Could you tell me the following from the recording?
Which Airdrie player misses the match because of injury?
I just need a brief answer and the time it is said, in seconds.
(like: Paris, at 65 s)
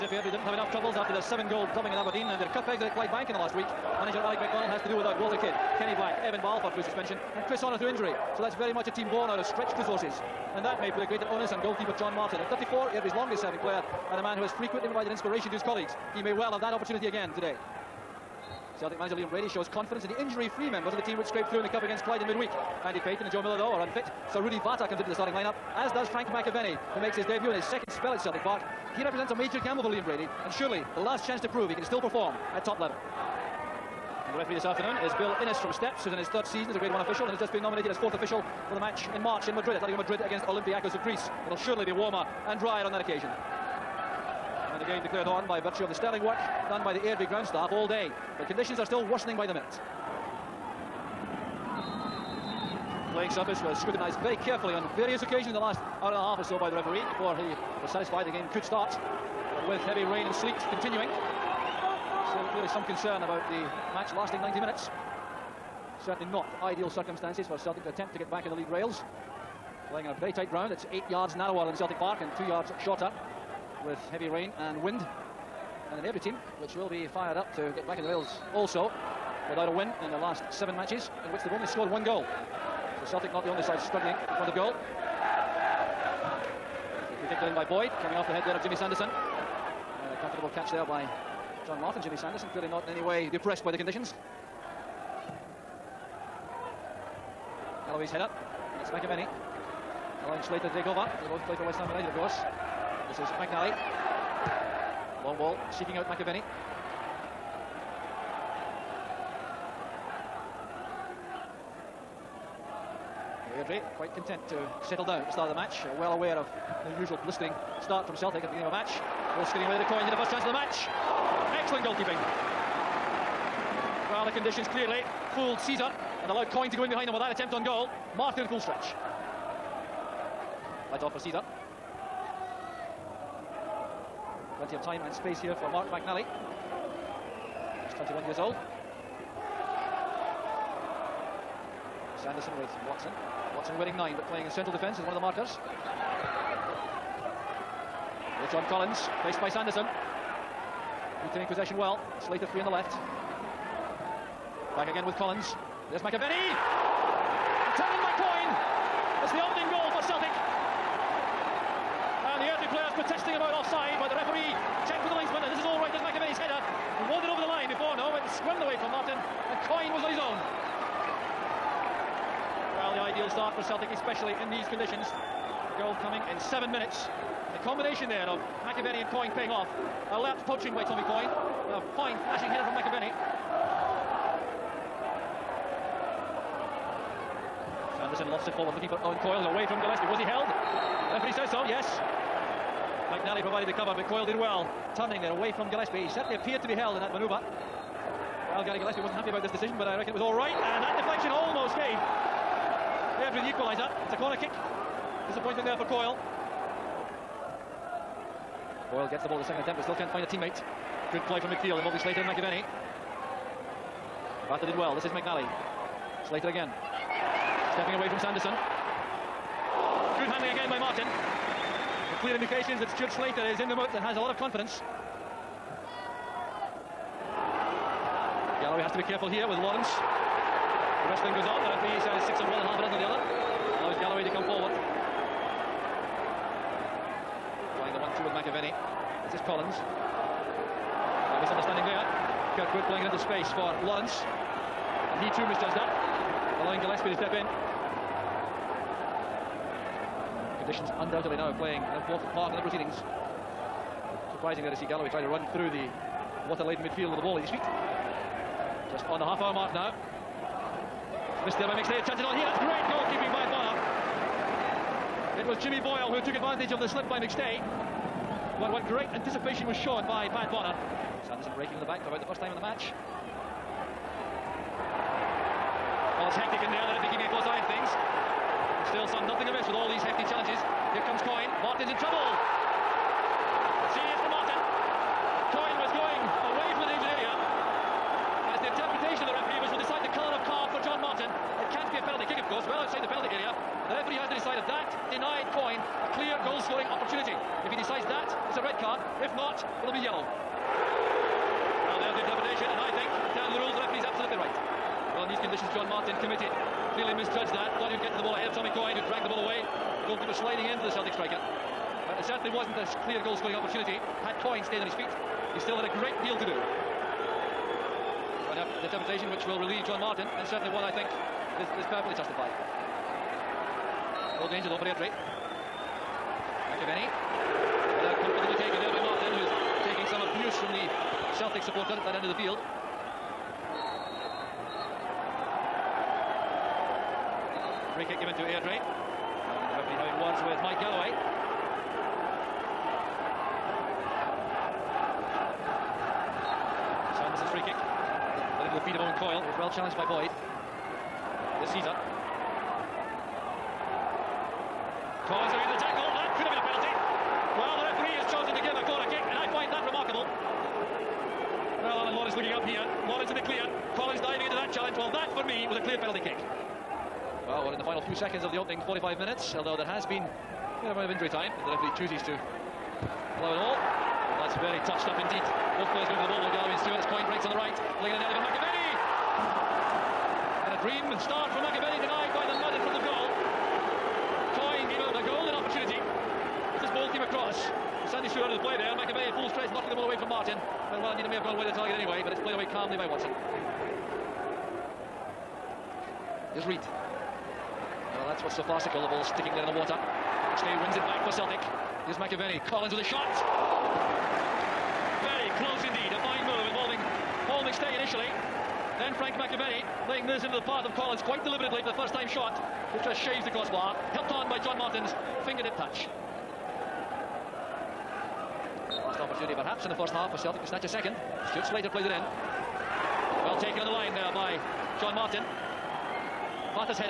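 Chris Honor, at 7 s.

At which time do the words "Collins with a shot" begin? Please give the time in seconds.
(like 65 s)
402 s.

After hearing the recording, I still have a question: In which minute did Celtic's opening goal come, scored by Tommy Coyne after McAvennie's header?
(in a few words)
7.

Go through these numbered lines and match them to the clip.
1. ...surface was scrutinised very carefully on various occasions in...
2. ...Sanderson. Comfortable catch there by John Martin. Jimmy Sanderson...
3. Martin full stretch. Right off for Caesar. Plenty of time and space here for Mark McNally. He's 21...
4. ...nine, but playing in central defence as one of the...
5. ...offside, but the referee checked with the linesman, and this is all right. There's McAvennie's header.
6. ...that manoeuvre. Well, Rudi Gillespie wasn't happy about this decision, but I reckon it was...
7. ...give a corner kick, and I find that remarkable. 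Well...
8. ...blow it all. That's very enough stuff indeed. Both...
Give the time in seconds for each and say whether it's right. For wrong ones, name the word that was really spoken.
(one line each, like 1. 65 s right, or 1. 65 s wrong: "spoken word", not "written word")
1. 53 s right
2. 88 s right
3. 128 s right
4. 143 s right
5. 163 s right
6. 197 s wrong: "Gary", not "Rudi"
7. 358 s right
8. 373 s wrong: "tough", not "enough".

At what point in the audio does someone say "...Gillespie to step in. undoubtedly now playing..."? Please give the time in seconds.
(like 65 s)
246 s.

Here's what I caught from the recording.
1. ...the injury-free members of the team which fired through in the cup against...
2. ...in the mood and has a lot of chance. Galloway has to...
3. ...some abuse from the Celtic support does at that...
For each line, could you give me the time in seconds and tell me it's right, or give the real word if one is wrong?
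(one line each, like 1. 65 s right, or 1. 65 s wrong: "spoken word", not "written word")
1. 20 s wrong: "scraped", not "fired"
2. 223 s wrong: "confidence", not "chance"
3. 330 s right.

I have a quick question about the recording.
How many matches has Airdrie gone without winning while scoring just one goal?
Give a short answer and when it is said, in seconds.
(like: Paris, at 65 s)
7, at 80 s.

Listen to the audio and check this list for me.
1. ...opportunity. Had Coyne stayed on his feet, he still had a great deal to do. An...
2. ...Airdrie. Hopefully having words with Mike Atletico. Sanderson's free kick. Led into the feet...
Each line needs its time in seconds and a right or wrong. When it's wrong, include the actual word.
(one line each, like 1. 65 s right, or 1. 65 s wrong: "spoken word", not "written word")
1. 313 s right
2. 338 s wrong: "Galloway", not "Atletico".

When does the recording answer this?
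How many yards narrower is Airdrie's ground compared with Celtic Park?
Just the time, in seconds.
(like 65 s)
70 s.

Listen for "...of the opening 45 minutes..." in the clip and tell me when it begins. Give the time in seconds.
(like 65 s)
368 s.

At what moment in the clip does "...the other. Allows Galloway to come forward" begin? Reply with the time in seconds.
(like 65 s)
232 s.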